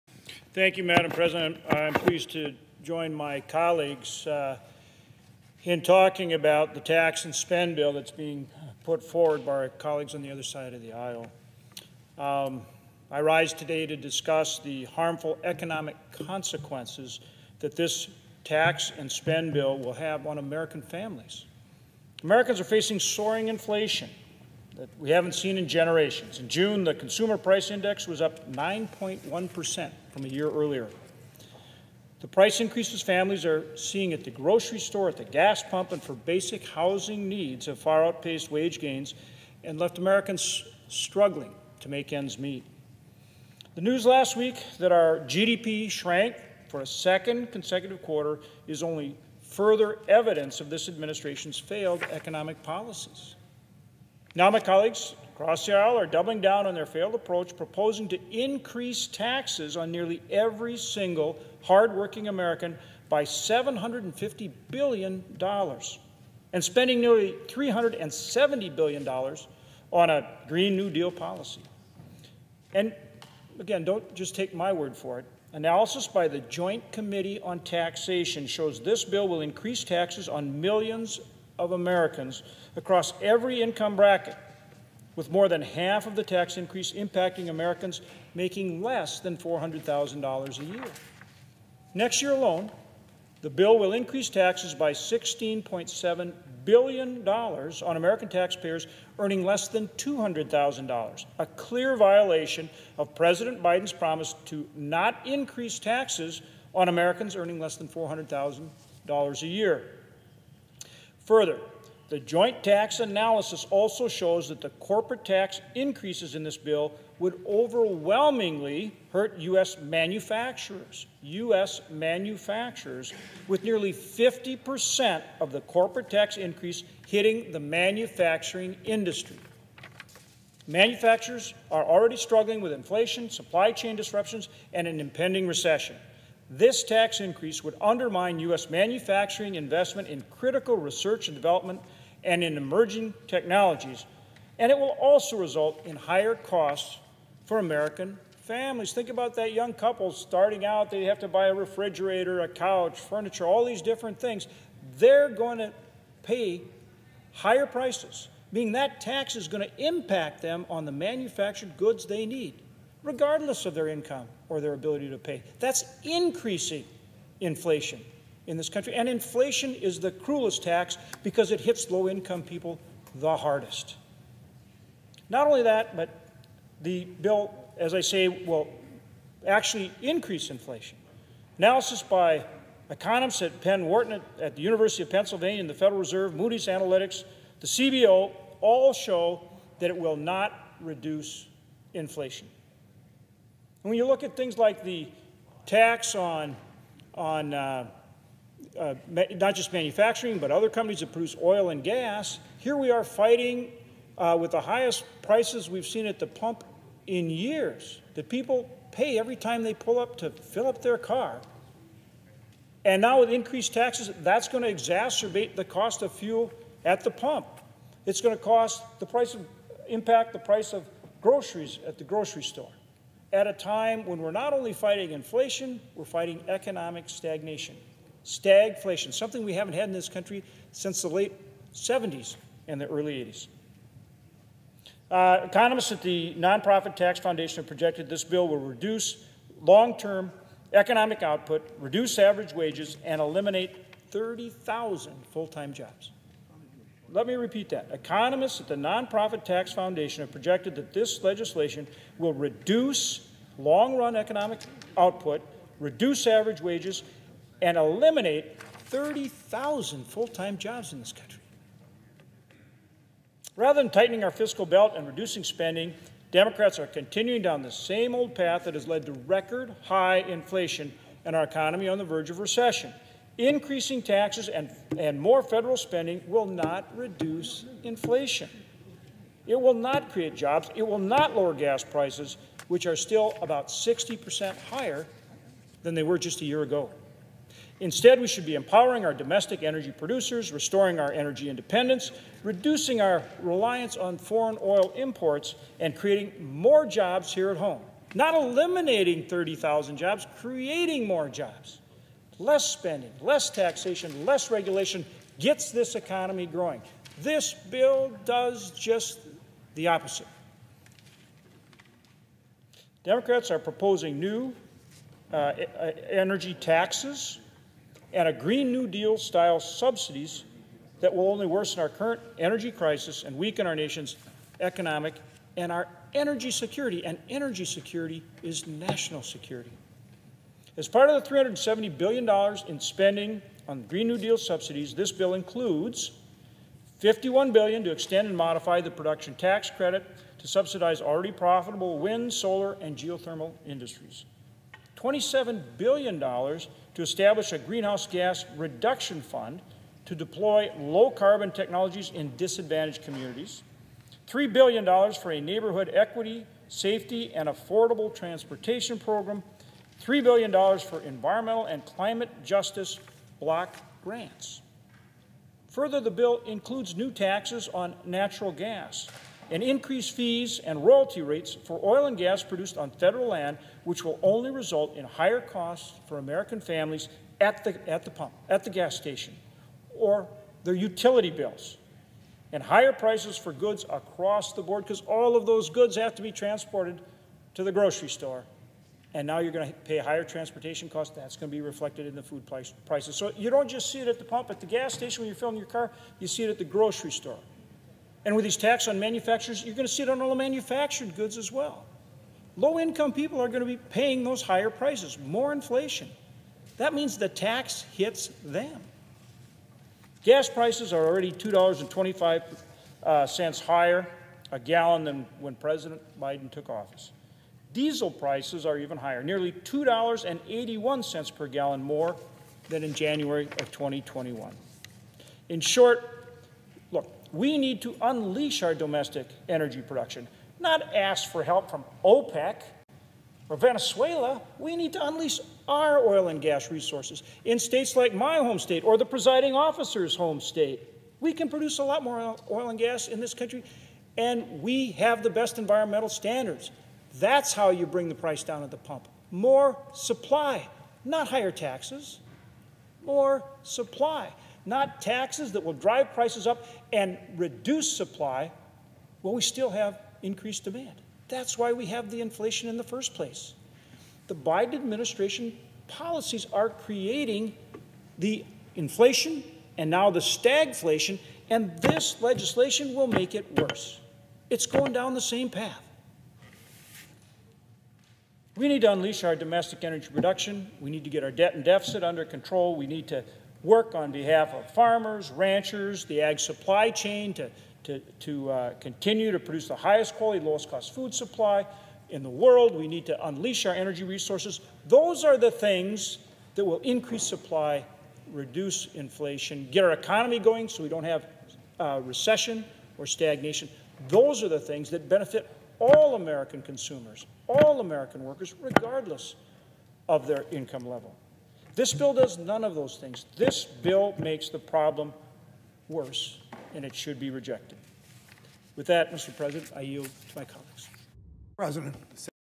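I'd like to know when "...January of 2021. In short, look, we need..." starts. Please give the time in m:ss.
7:02.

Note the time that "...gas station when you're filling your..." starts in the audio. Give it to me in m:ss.
6:34.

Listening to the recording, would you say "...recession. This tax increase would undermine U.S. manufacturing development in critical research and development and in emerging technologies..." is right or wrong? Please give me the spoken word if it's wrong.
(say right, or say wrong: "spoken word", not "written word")
wrong: "investment", not "development".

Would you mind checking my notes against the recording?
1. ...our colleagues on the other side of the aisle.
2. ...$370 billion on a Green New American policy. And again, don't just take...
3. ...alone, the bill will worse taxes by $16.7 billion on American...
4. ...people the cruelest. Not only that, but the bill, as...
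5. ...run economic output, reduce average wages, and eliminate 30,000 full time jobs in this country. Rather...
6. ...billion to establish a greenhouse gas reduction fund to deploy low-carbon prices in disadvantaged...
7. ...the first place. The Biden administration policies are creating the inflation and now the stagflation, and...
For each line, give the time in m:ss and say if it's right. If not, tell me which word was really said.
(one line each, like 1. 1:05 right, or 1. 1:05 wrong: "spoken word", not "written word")
1. 0:09 right
2. 1:07 wrong: "Deal", not "American"
3. 1:32 wrong: "increase", not "worse"
4. 2:52 wrong: "hardest", not "cruelest"
5. 4:13 right
6. 5:45 wrong: "technologies", not "prices"
7. 7:42 right.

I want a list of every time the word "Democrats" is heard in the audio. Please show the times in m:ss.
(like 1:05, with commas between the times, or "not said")
4:26, 5:13.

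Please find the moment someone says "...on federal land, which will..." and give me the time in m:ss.
6:12.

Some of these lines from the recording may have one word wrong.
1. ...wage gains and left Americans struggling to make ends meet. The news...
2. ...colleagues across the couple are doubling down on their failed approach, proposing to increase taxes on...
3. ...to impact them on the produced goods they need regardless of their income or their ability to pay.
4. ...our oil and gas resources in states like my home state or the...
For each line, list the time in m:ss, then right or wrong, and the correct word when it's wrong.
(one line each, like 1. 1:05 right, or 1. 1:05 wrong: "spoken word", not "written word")
1. 0:38 right
2. 0:54 wrong: "aisle", not "couple"
3. 2:39 wrong: "manufactured", not "produced"
4. 7:15 right.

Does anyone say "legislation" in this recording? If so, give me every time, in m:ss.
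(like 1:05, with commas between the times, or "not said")
4:11, 7:52.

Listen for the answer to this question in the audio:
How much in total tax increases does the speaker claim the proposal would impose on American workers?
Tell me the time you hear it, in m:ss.
1:03.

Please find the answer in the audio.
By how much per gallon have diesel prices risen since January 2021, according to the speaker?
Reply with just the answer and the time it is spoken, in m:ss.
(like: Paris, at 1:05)
$2.81, at 6:59.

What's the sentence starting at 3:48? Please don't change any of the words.
Stagflation, something we haven't had in this country since the late 70s and the early 80s.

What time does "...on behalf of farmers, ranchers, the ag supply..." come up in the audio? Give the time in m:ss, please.
8:03.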